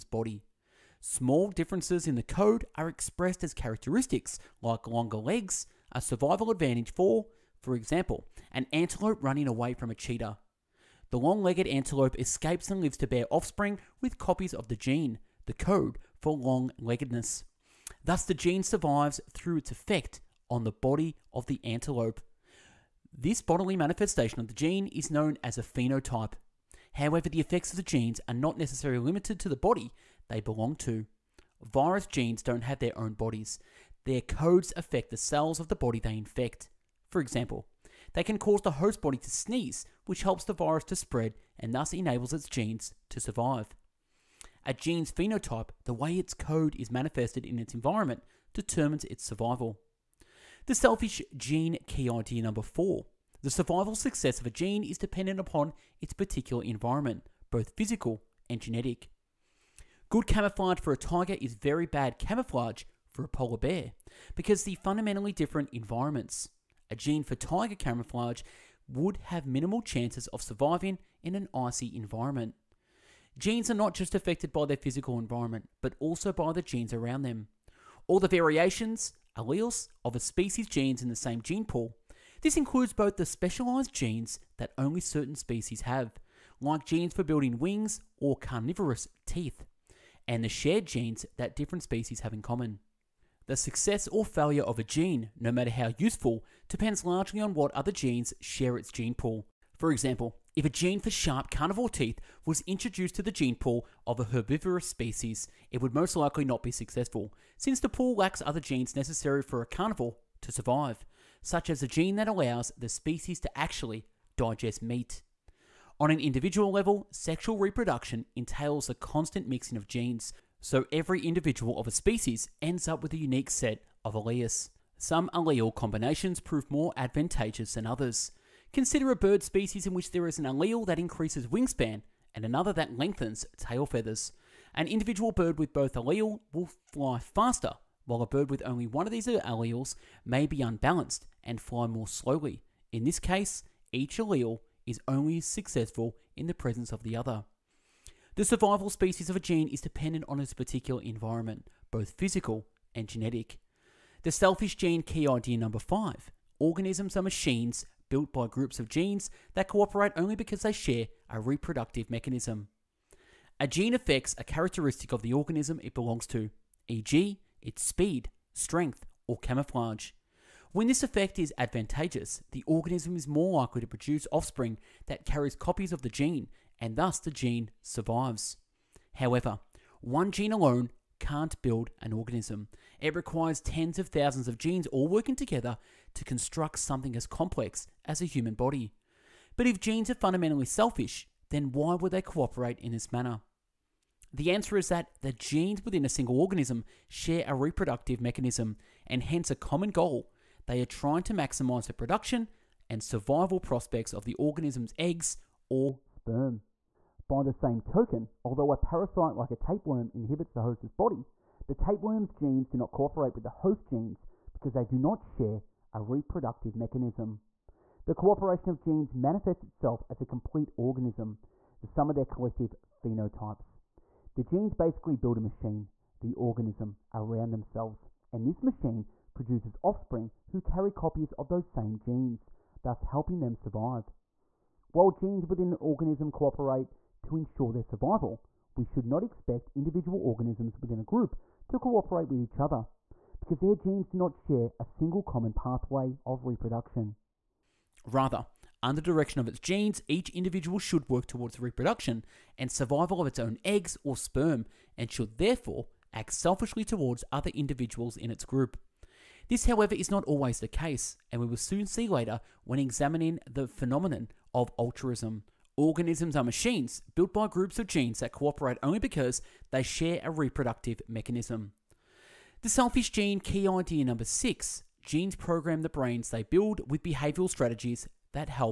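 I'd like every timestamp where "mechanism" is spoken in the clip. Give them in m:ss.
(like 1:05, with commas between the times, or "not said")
2:42, 3:18, 3:36, 4:31.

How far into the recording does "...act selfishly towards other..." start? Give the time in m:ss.
4:16.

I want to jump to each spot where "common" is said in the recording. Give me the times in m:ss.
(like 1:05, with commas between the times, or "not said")
1:32, 3:19, 4:05.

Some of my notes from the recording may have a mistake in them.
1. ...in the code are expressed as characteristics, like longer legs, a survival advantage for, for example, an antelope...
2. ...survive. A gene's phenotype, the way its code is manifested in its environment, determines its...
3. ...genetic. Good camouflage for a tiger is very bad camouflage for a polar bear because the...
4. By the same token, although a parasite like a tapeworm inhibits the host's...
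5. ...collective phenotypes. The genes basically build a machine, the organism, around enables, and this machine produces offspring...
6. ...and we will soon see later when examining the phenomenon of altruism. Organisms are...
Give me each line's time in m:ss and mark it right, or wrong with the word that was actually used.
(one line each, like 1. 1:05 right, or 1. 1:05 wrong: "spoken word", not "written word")
1. 0:02 right
2. 0:43 right
3. 0:58 right
4. 3:27 right
5. 3:42 wrong: "themselves", not "enables"
6. 4:21 right.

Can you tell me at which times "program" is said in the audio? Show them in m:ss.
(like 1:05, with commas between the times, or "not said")
4:35.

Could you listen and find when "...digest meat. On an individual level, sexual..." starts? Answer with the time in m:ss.
1:54.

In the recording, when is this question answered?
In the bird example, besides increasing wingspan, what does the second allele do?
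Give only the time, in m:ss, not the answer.
2:12.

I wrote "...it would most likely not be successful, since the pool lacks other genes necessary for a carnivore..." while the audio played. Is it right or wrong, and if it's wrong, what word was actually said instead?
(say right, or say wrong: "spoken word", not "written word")
right.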